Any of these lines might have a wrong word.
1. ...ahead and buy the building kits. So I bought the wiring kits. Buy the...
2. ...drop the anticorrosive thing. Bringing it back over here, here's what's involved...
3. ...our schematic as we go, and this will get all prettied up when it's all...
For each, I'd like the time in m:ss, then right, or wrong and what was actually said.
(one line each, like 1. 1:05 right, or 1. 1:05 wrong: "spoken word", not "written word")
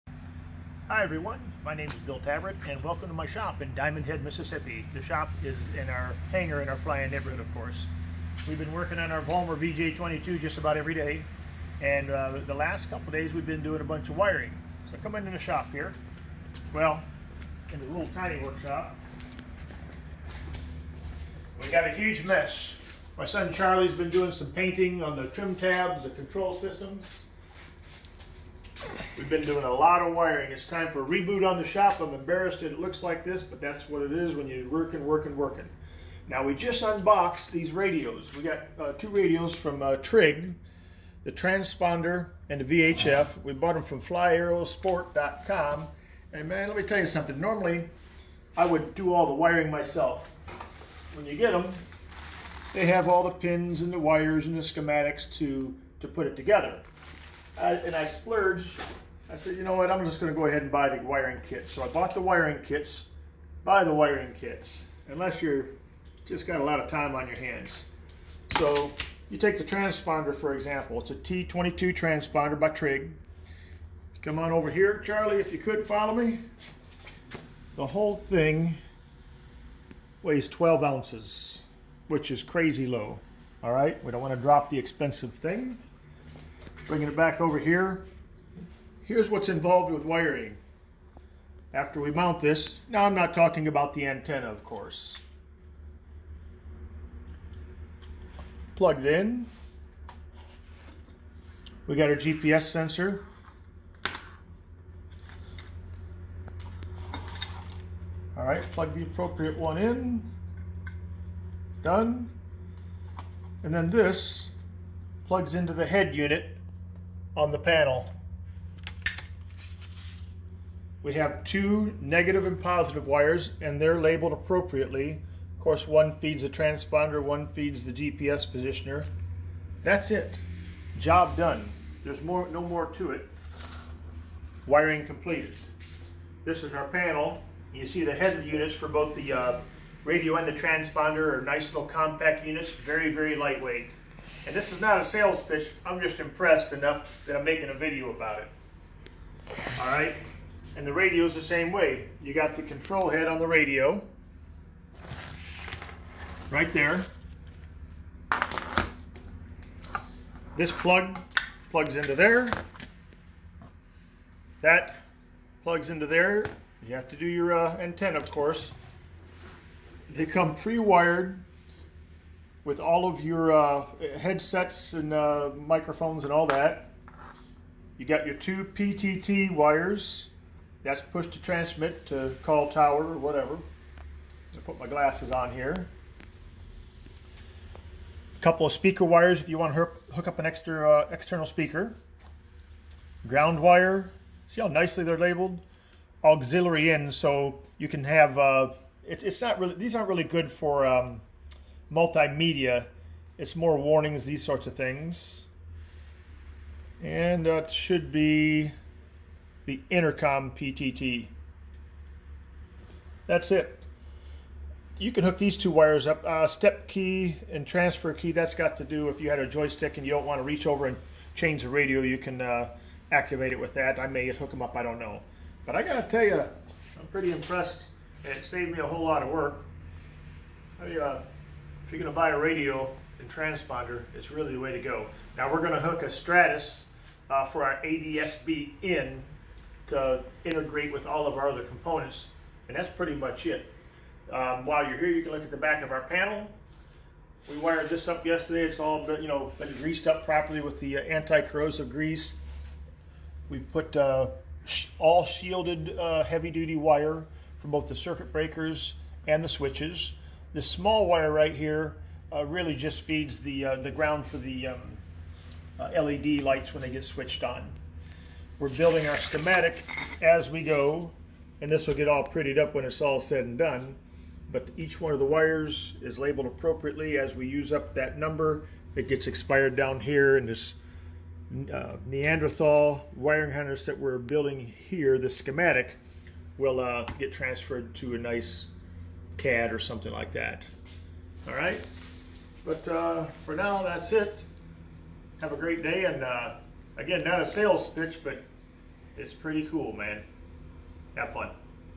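1. 1:00 wrong: "wiring", not "building"
2. 1:24 wrong: "expensive", not "anticorrosive"
3. 4:29 right.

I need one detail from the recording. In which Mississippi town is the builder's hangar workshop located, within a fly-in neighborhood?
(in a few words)
Diamondhead.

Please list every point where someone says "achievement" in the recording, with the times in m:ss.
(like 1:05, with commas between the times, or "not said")
not said.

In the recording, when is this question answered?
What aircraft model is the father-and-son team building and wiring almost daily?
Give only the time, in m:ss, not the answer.
0:09.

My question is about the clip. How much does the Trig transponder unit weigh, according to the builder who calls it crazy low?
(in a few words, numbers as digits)
12 ounces.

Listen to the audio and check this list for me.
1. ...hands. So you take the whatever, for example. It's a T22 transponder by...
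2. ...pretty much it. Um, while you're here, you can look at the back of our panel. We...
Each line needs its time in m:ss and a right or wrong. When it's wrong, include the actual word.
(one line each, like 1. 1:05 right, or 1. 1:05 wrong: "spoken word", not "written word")
1. 1:07 wrong: "transponder", not "whatever"
2. 4:02 right.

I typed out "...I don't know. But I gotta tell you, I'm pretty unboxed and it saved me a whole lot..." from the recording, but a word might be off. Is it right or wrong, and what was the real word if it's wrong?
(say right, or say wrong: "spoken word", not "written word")
wrong: "impressed", not "unboxed".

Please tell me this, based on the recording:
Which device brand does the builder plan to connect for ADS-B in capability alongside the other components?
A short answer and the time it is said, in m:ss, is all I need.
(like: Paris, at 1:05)
Stratus, at 3:56.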